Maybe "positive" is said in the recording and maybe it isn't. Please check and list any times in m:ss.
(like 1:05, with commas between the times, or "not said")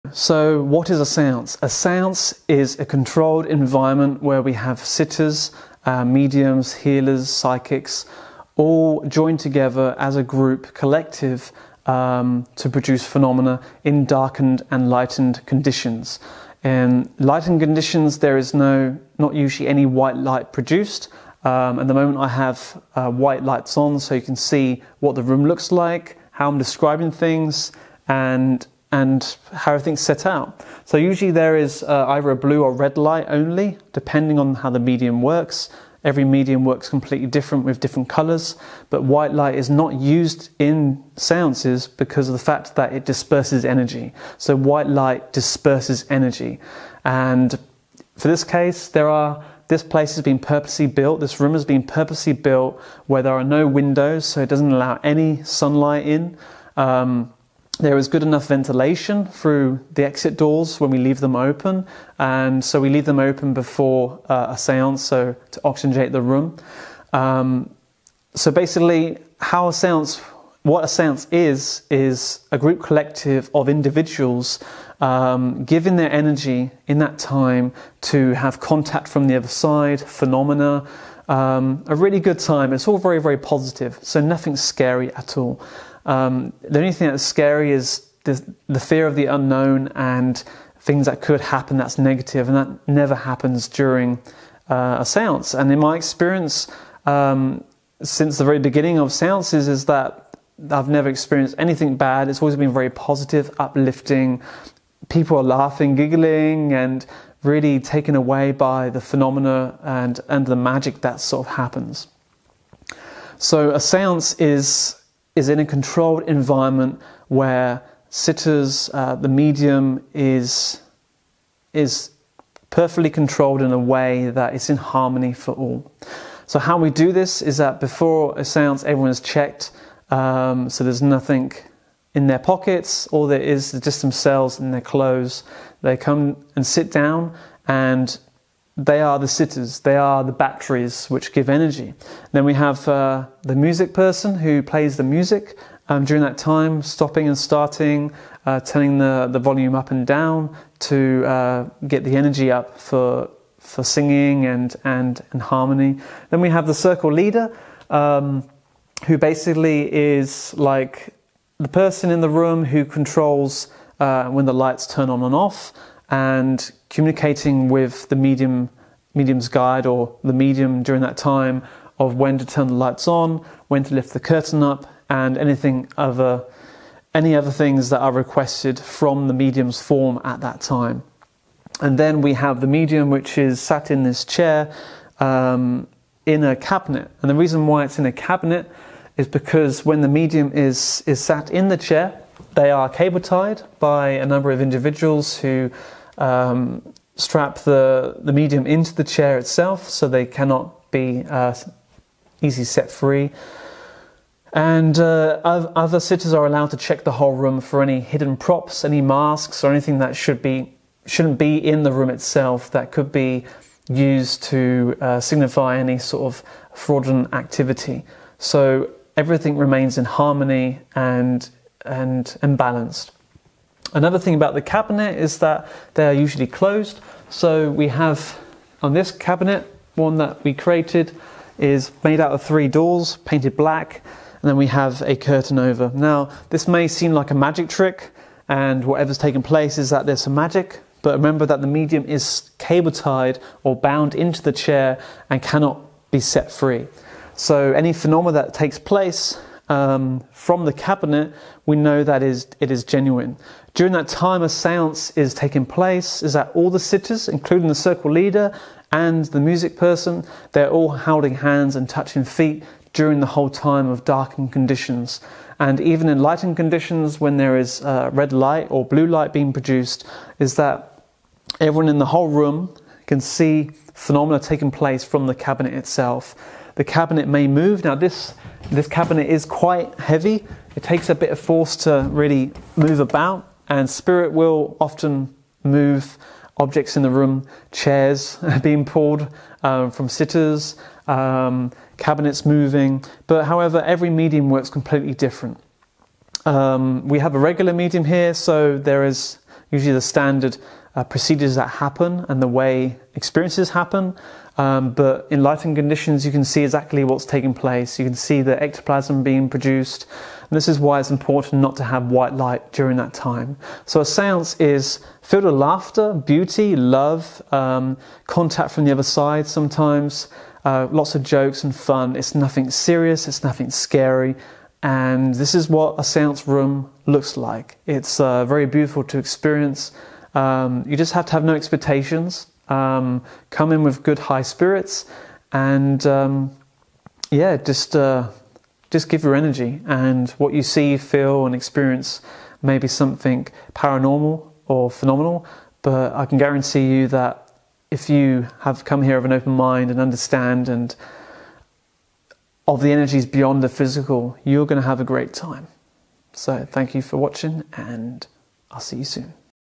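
1:23, 1:42.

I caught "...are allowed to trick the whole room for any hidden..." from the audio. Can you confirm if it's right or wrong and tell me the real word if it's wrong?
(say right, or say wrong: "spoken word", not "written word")
wrong: "check", not "trick".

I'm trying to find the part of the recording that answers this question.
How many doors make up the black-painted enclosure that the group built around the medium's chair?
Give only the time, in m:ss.
3:52.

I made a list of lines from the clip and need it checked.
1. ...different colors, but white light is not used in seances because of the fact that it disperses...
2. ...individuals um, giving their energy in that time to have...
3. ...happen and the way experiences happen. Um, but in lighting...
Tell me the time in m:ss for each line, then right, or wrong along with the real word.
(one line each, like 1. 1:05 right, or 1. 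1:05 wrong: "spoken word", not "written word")
1. 0:37 right
2. 1:13 right
3. 5:01 right.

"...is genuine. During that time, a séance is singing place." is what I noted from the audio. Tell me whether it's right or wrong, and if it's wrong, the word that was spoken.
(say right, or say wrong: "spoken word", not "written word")
wrong: "taking", not "singing".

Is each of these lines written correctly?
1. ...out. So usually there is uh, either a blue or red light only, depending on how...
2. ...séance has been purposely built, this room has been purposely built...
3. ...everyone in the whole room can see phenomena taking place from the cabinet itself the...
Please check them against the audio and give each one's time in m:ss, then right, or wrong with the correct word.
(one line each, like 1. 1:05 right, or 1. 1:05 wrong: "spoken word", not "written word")
1. 0:30 right
2. 0:49 wrong: "place", not "séance"
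3. 4:31 right.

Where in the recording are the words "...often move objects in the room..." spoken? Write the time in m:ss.
4:44.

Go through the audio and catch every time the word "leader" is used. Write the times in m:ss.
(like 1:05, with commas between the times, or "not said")
2:37, 4:18.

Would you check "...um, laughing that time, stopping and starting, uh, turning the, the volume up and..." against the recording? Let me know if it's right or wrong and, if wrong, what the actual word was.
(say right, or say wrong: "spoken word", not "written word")
wrong: "during", not "laughing".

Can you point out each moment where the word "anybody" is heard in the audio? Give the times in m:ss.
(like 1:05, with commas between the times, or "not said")
not said.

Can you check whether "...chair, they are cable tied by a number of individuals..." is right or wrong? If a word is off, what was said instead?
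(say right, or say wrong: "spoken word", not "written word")
right.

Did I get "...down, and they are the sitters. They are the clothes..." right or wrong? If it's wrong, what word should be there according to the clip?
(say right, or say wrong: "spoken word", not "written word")
wrong: "batteries", not "clothes".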